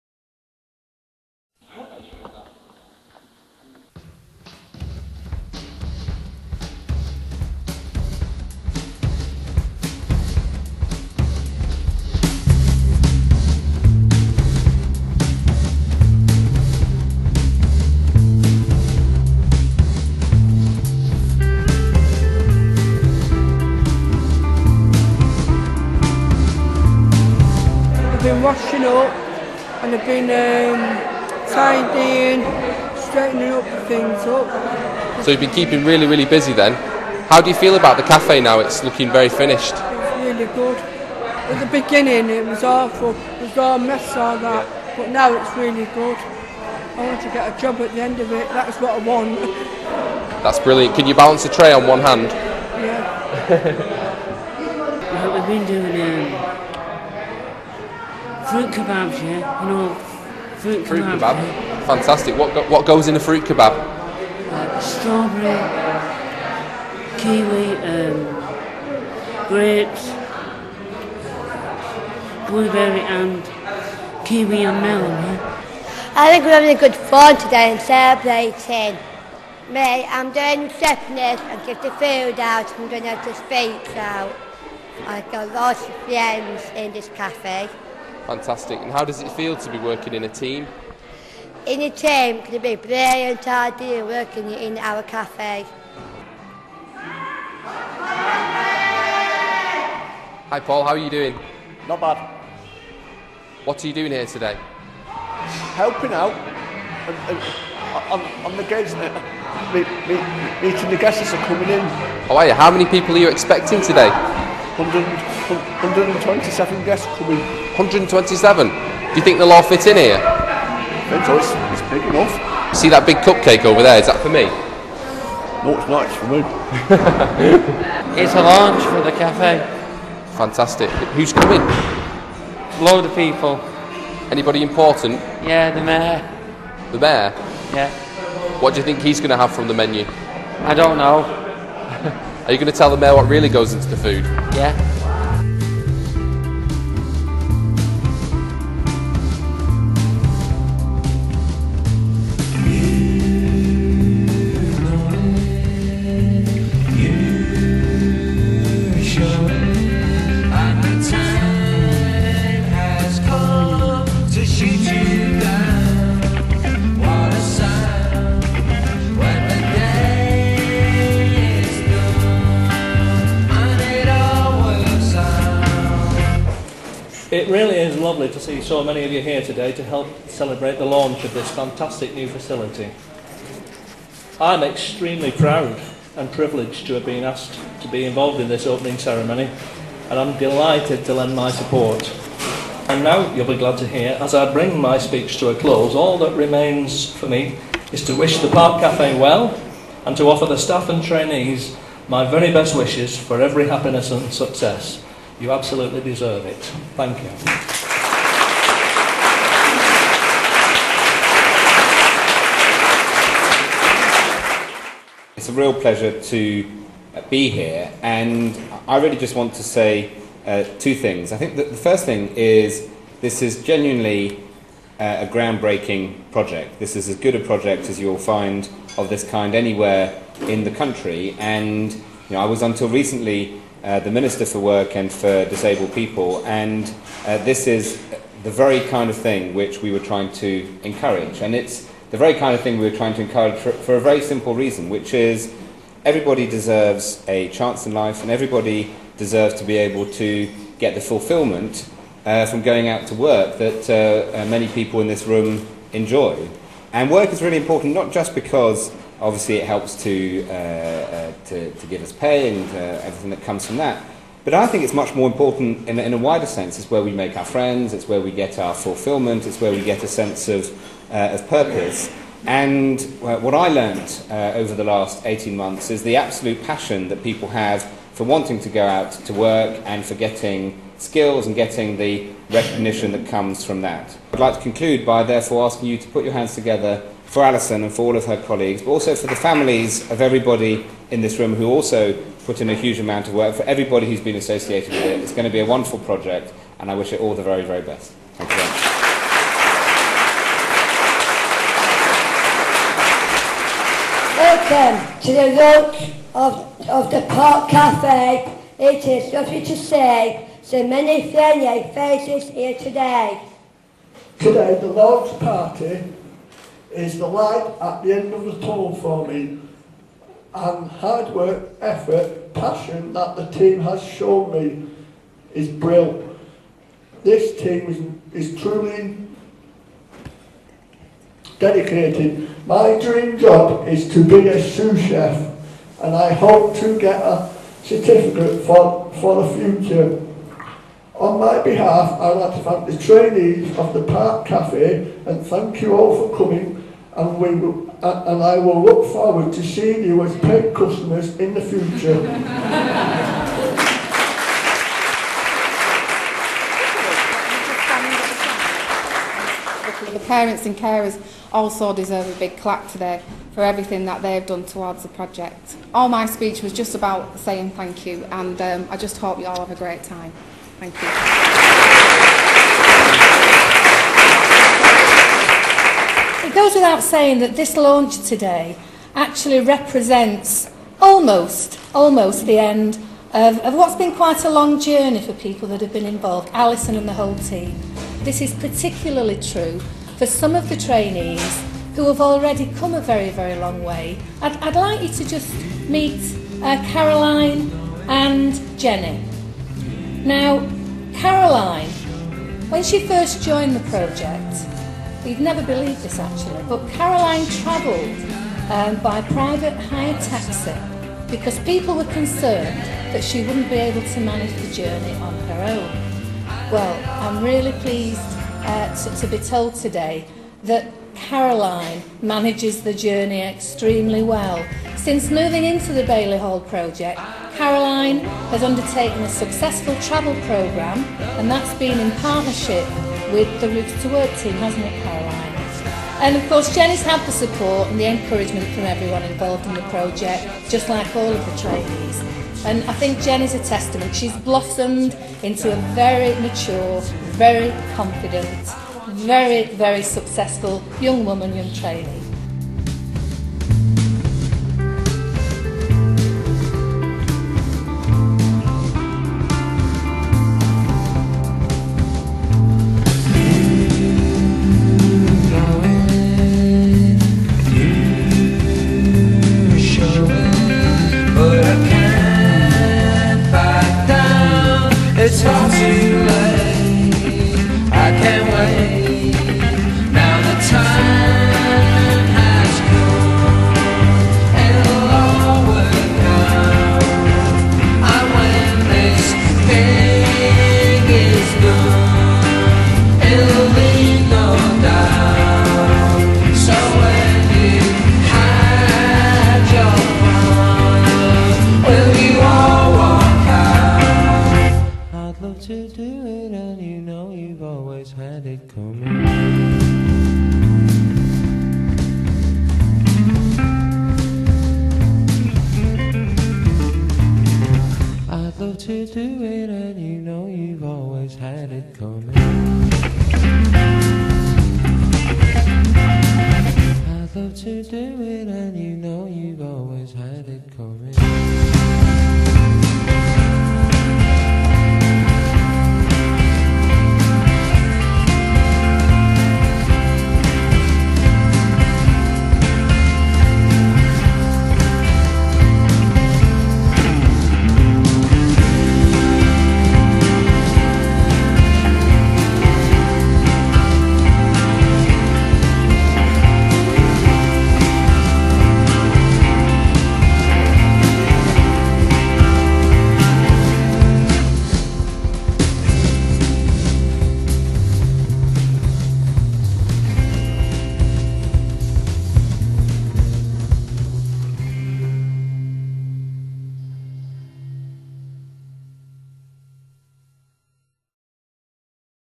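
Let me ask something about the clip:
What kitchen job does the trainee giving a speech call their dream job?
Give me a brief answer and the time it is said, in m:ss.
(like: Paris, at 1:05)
sous chef, at 5:34.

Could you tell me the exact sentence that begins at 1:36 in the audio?
Hi Paul, how are you doing?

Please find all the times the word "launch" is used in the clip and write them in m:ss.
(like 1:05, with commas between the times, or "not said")
2:08, 3:00, 5:14, 6:17.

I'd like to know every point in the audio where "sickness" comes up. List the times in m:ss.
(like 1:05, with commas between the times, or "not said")
1:20.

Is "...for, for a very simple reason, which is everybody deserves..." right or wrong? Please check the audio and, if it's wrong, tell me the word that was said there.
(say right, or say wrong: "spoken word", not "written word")
right.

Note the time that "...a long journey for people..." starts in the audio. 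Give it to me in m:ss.
6:24.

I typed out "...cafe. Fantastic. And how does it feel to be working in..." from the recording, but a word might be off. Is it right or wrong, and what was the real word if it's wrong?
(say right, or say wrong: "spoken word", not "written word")
right.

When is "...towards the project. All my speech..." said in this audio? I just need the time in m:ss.
6:04.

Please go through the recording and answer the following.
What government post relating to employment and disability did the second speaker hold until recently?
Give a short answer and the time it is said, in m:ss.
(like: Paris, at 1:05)
Minister for Work and for Disabled People, at 3:54.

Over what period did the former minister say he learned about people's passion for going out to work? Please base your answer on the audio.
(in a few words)
18 months.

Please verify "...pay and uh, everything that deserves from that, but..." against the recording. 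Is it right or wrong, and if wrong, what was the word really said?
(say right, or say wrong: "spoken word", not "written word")
wrong: "comes", not "deserves".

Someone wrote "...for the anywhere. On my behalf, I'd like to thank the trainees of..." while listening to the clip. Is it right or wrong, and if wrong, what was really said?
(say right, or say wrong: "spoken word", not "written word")
wrong: "future", not "anywhere".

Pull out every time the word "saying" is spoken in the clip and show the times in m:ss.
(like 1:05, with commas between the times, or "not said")
6:07, 6:17.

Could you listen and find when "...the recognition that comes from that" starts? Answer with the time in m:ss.
4:41.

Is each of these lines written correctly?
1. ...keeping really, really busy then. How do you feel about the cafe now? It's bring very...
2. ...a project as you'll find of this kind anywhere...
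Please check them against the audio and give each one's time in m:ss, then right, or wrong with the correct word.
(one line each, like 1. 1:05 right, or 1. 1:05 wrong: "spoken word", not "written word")
1. 0:35 wrong: "looking", not "bring"
2. 3:47 right.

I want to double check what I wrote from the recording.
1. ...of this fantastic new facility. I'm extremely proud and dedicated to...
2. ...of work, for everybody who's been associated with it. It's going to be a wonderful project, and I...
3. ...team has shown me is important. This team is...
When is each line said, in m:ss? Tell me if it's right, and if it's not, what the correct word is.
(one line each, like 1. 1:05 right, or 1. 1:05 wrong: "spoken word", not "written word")
1. 3:01 wrong: "privileged", not "dedicated"
2. 4:53 right
3. 5:23 wrong: "brilliant", not "important".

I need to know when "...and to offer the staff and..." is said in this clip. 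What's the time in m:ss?
3:20.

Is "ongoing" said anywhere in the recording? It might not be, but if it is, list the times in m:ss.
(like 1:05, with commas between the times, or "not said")
not said.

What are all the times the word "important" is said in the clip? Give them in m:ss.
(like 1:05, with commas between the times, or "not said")
2:14, 4:17, 4:25.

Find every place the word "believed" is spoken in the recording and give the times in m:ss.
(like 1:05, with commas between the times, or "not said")
6:45.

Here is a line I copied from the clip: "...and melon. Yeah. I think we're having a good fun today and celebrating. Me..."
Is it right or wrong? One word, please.
right.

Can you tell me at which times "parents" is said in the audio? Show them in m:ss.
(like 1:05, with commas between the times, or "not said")
6:00.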